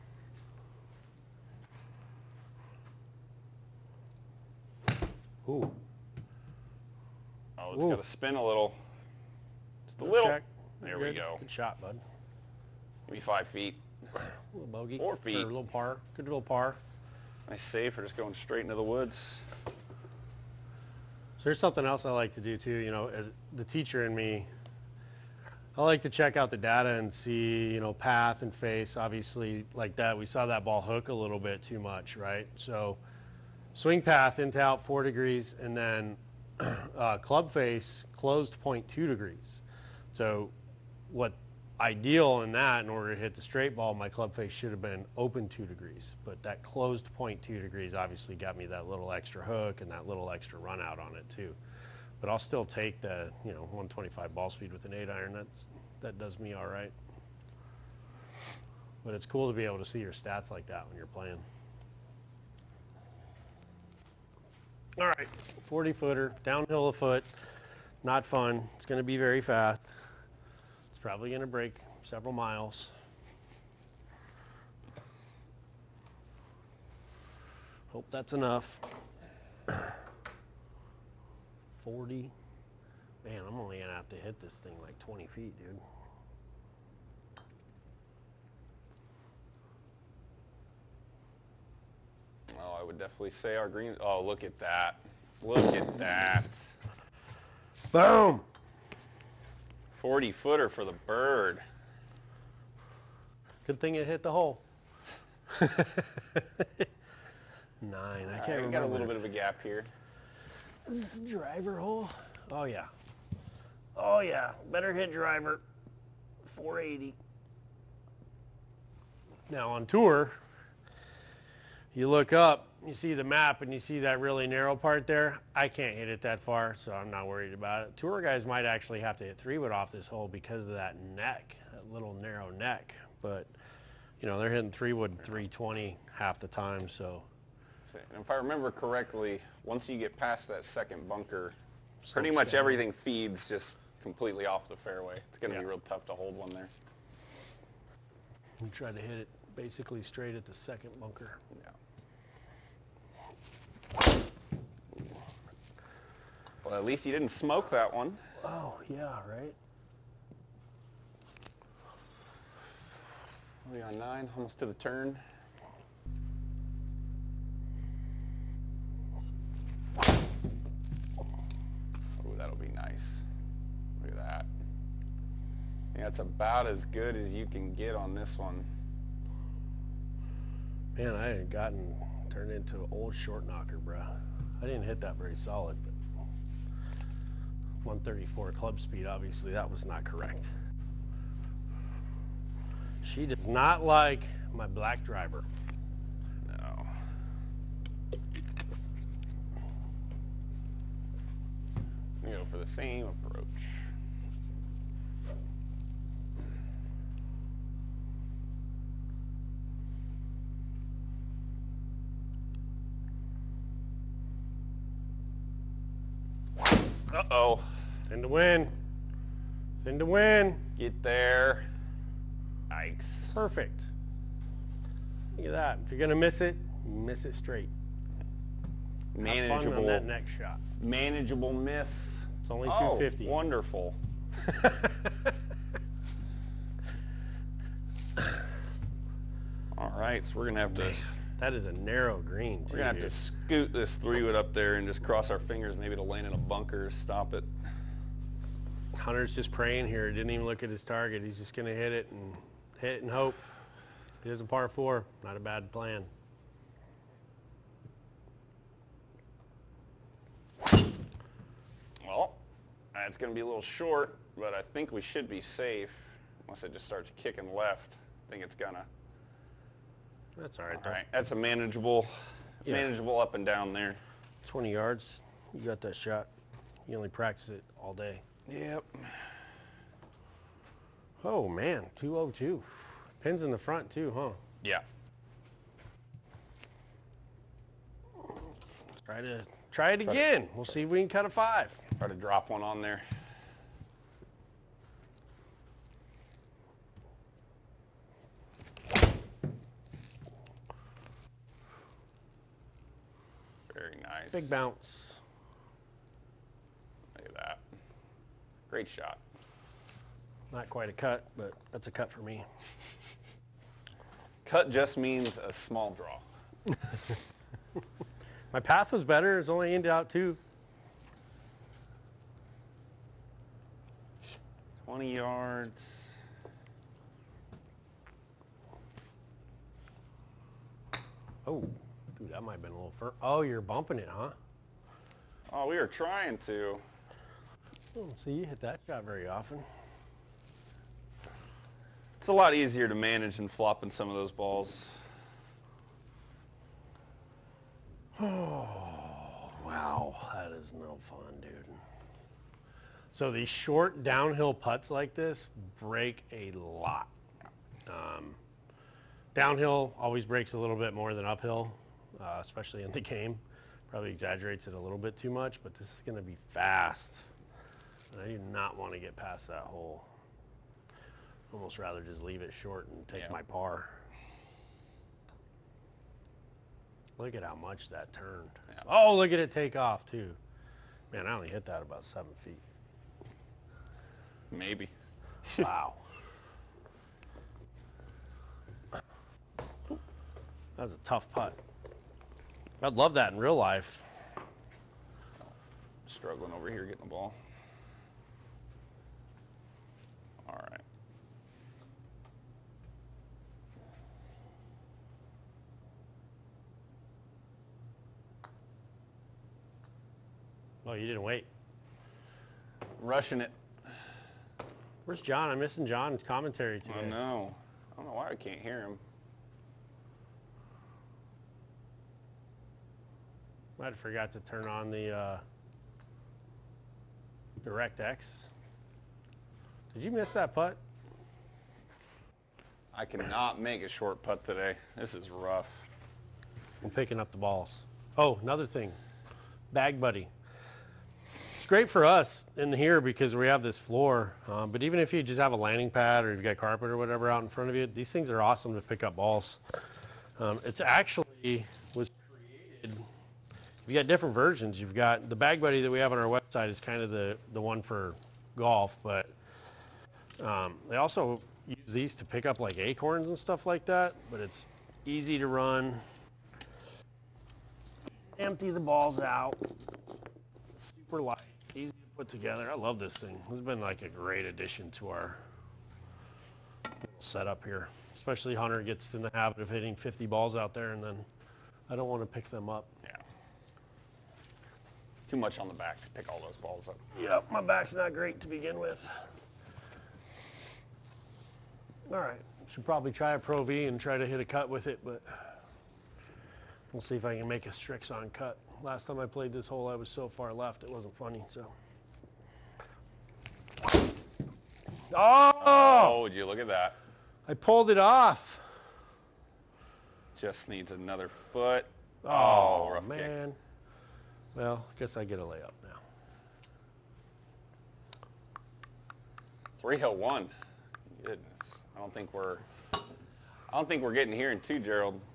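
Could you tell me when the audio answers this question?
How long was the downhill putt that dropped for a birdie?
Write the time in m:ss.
1:40.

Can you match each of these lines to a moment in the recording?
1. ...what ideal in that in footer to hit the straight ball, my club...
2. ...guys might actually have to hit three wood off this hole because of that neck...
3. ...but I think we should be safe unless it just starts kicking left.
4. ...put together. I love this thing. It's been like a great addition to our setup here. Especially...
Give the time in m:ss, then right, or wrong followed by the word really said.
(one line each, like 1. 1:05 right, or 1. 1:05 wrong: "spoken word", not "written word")
1. 0:41 wrong: "order", not "footer"
2. 2:08 right
3. 4:24 right
4. 7:52 right.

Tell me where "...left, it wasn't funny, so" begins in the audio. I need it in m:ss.
8:20.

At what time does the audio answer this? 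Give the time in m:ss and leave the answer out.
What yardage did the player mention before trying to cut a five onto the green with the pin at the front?
4:41.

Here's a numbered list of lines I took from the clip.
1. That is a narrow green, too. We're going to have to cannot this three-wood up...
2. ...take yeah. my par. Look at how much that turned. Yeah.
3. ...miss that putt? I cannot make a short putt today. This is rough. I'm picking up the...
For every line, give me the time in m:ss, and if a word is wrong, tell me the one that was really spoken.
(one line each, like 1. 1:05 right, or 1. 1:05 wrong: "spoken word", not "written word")
1. 4:01 wrong: "scoot", not "cannot"
2. 6:13 right
3. 7:10 right.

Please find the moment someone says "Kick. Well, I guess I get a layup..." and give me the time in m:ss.
8:33.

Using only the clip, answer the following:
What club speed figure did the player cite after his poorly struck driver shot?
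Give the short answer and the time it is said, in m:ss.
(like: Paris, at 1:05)
134, at 3:07.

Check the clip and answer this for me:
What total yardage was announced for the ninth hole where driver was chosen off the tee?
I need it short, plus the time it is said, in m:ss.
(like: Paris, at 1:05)
480, at 1:56.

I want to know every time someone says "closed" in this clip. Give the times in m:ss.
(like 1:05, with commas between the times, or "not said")
0:38, 0:46.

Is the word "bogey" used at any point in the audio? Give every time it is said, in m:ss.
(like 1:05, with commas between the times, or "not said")
0:14.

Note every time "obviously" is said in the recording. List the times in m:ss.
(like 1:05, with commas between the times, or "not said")
0:28, 0:47, 3:09.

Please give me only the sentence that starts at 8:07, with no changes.
Yep, my back's not great to begin with.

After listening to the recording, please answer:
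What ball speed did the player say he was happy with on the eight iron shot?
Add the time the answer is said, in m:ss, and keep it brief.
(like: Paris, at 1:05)
125, at 0:53.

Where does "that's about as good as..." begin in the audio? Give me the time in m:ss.
2:55.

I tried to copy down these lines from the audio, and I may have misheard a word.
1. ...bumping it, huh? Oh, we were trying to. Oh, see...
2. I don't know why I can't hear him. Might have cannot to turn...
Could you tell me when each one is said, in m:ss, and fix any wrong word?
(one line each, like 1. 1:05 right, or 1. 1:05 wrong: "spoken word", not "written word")
1. 5:33 right
2. 6:57 wrong: "forgot", not "cannot".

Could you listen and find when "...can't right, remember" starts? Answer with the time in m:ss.
1:48.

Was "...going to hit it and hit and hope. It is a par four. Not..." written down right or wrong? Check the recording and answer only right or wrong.
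right.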